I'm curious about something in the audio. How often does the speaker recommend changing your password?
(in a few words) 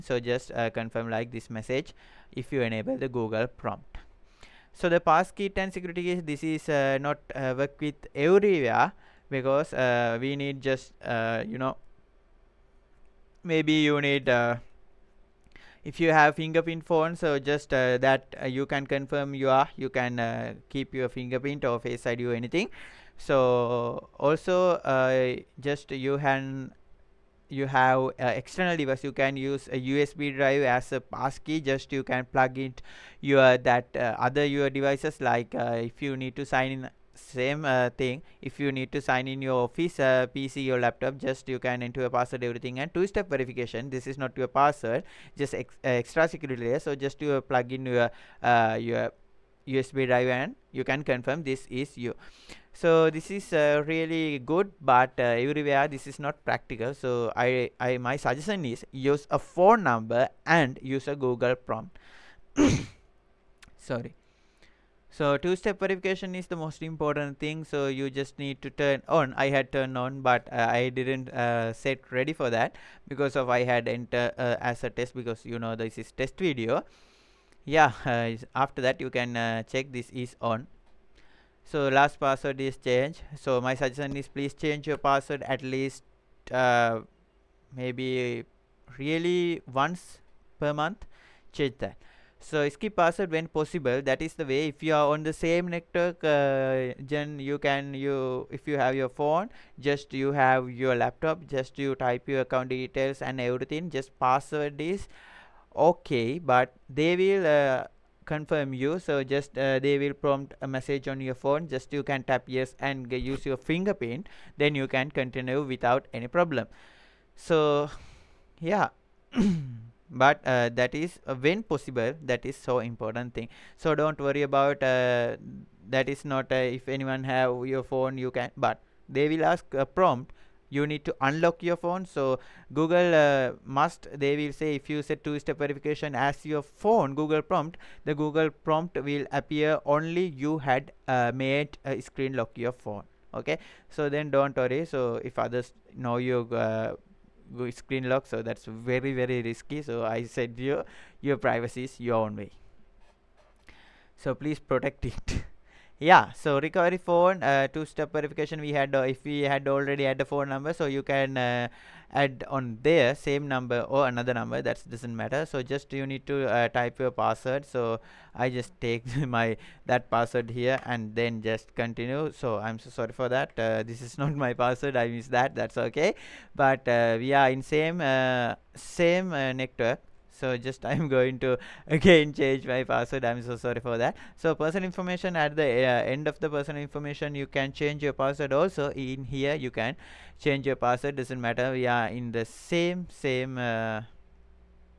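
once per month.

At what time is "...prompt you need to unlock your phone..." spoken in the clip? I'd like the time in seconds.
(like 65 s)
129 s.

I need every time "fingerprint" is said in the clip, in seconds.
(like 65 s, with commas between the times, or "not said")
16 s, 21 s, 113 s.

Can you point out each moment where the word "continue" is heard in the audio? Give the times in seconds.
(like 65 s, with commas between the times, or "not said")
115 s, 171 s.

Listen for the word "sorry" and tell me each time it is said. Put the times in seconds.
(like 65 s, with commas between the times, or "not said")
63 s, 172 s, 183 s.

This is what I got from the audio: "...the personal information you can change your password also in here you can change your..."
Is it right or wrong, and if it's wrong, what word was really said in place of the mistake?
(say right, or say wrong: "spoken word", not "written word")
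right.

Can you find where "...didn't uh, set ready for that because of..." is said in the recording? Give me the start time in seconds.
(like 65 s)
70 s.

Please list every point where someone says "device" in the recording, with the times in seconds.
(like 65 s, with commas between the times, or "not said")
28 s, 34 s.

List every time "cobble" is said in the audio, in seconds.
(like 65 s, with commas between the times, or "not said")
not said.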